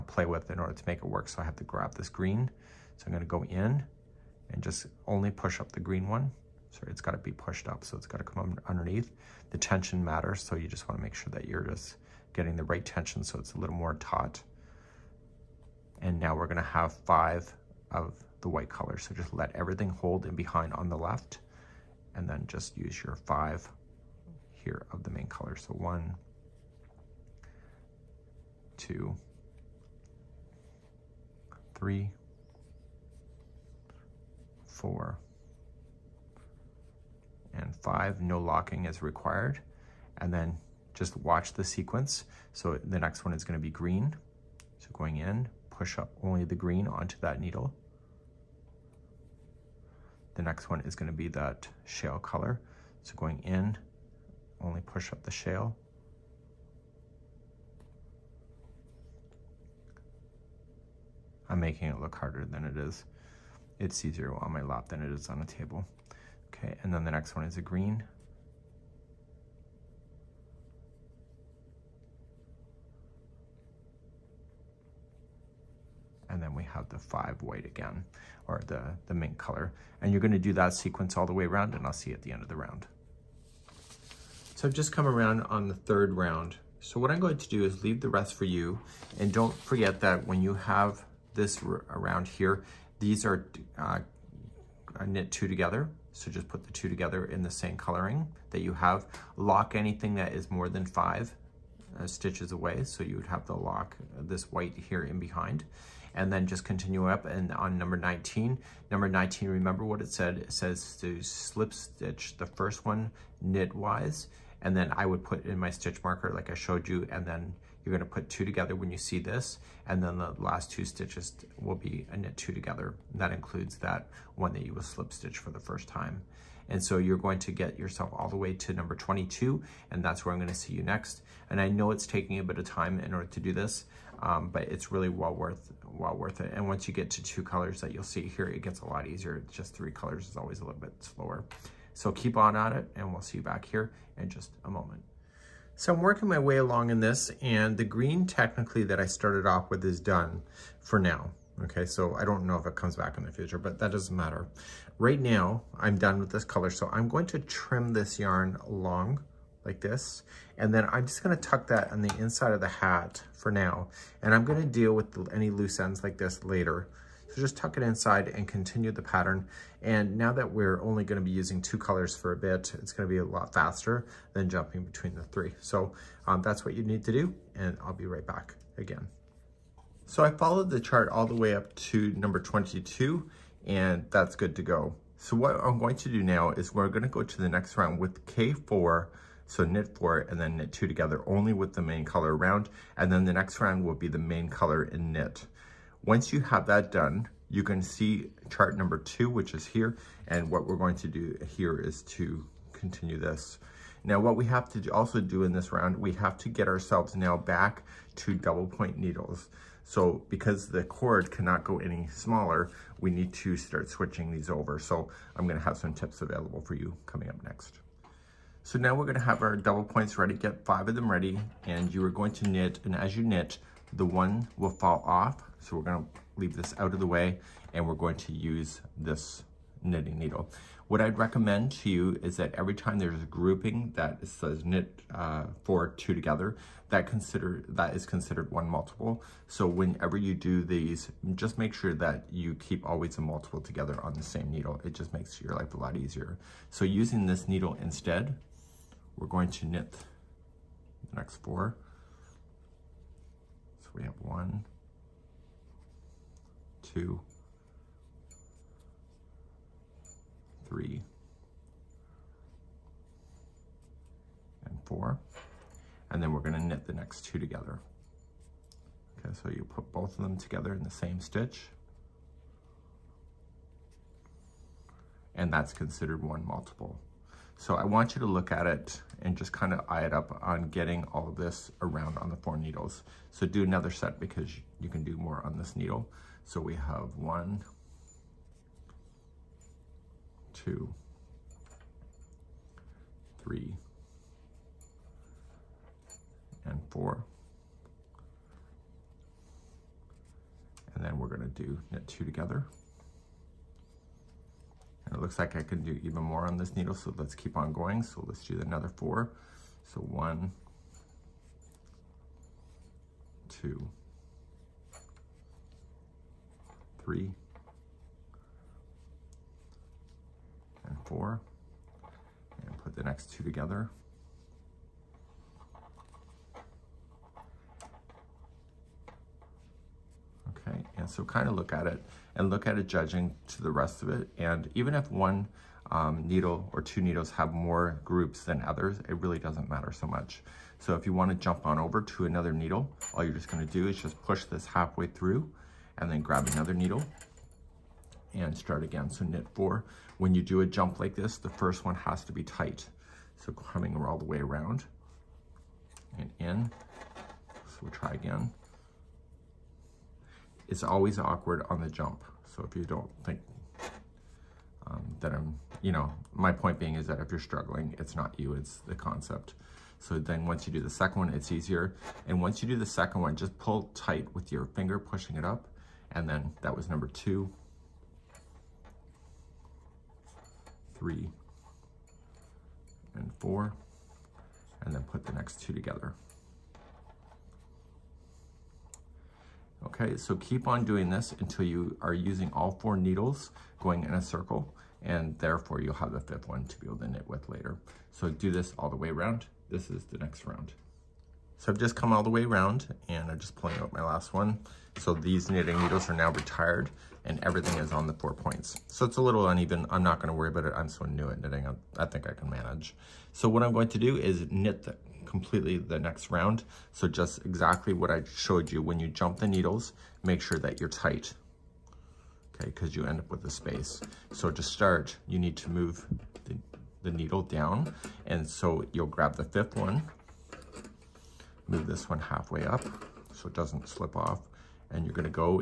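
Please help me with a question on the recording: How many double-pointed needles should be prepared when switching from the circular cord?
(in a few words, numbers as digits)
5.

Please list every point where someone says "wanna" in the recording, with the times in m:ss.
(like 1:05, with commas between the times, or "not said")
0:10, 5:41.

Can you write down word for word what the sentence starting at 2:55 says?
So um, that's what you need to do and I'll be right back again.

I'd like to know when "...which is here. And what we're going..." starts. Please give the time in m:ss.
3:19.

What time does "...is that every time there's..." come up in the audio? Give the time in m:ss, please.
3:52.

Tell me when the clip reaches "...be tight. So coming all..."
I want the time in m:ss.
5:52.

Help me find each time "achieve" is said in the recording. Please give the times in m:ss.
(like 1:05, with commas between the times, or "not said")
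not said.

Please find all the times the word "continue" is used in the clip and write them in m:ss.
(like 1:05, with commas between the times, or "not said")
1:46, 2:48, 3:22.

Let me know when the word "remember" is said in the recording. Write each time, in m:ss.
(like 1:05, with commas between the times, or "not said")
1:49.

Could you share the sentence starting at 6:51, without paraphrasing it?
I, I think I can manage.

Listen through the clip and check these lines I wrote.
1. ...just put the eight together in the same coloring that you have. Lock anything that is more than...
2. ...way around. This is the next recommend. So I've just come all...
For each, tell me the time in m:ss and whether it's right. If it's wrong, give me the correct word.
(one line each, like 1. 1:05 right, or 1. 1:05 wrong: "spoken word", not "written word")
1. 1:36 wrong: "two", not "eight"
2. 6:38 wrong: "round", not "recommend".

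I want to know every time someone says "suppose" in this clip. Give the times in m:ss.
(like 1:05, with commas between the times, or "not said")
not said.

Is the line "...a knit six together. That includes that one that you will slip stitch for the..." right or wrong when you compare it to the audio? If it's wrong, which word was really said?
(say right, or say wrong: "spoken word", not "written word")
wrong: "two", not "six".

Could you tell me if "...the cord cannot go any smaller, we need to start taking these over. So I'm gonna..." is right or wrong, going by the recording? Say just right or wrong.
wrong.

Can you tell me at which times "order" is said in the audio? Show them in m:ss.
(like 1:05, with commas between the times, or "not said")
0:00, 2:13.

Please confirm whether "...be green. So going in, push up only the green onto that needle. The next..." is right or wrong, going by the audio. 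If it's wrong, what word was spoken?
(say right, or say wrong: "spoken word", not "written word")
right.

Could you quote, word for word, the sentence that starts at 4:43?
So do another set because you can do more on this needle.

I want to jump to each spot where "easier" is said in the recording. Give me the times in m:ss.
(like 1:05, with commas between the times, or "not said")
1:04, 2:19, 4:05, 6:11.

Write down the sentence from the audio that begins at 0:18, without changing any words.
So just let everything hold in behind on the left and then just use your five here of the main color.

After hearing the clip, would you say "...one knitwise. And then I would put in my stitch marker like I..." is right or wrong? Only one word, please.
right.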